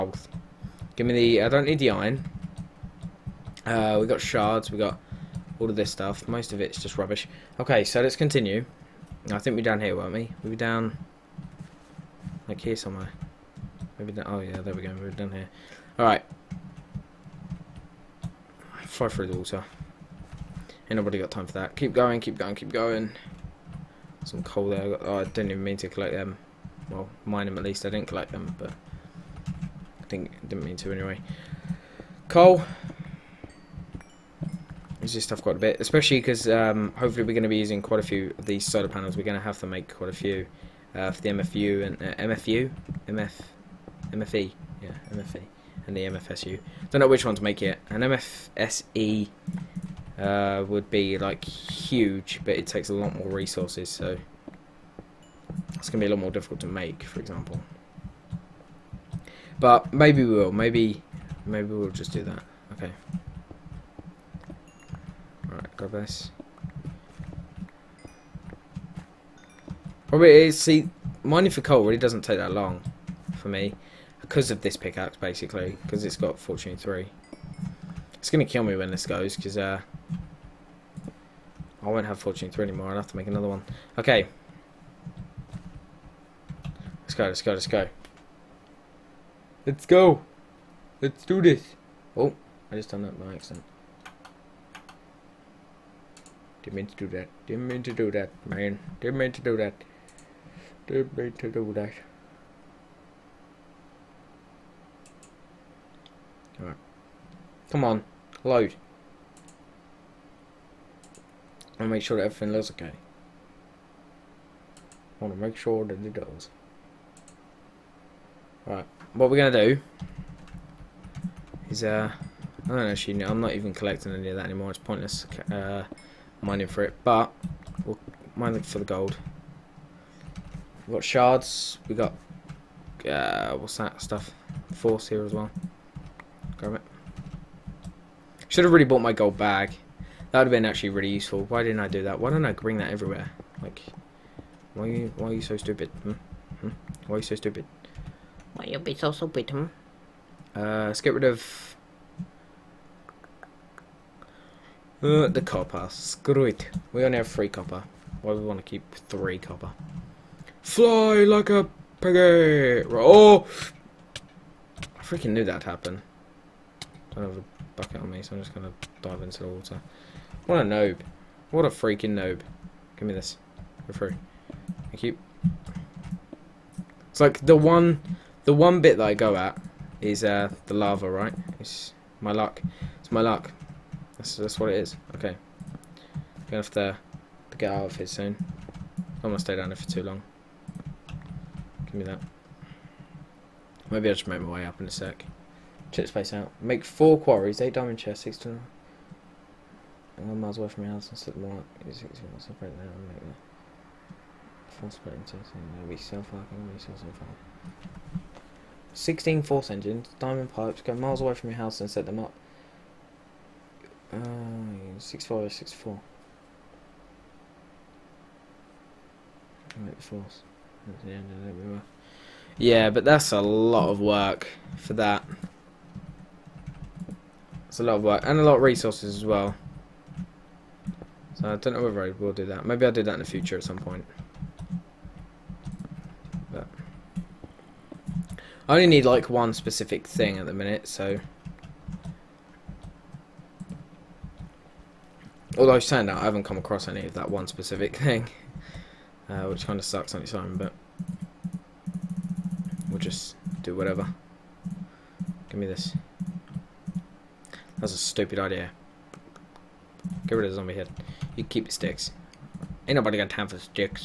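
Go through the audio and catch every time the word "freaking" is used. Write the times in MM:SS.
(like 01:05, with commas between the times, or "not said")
02:45, 02:51.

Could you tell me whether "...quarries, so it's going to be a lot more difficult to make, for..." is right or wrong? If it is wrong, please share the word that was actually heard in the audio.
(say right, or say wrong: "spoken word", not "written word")
wrong: "resources", not "quarries".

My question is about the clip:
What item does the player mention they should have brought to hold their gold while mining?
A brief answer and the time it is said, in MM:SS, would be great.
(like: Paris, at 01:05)
gold bag, at 02:19.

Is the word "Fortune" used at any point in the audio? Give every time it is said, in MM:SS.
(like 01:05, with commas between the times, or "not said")
01:16, 01:22.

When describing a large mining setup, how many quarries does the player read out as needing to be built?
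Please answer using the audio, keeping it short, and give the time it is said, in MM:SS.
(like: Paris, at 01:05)
4, at 03:16.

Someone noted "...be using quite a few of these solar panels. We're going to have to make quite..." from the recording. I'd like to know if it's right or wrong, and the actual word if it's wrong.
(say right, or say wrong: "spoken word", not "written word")
right.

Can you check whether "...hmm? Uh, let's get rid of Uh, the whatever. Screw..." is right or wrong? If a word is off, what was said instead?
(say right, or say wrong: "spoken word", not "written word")
wrong: "copper", not "whatever".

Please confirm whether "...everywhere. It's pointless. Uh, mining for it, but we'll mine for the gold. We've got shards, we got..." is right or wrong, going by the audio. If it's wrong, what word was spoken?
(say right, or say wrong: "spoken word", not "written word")
wrong: "anymore", not "everywhere".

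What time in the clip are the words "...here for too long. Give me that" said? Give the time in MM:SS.
03:09.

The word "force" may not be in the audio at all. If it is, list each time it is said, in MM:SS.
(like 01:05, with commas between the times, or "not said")
02:14, 03:29.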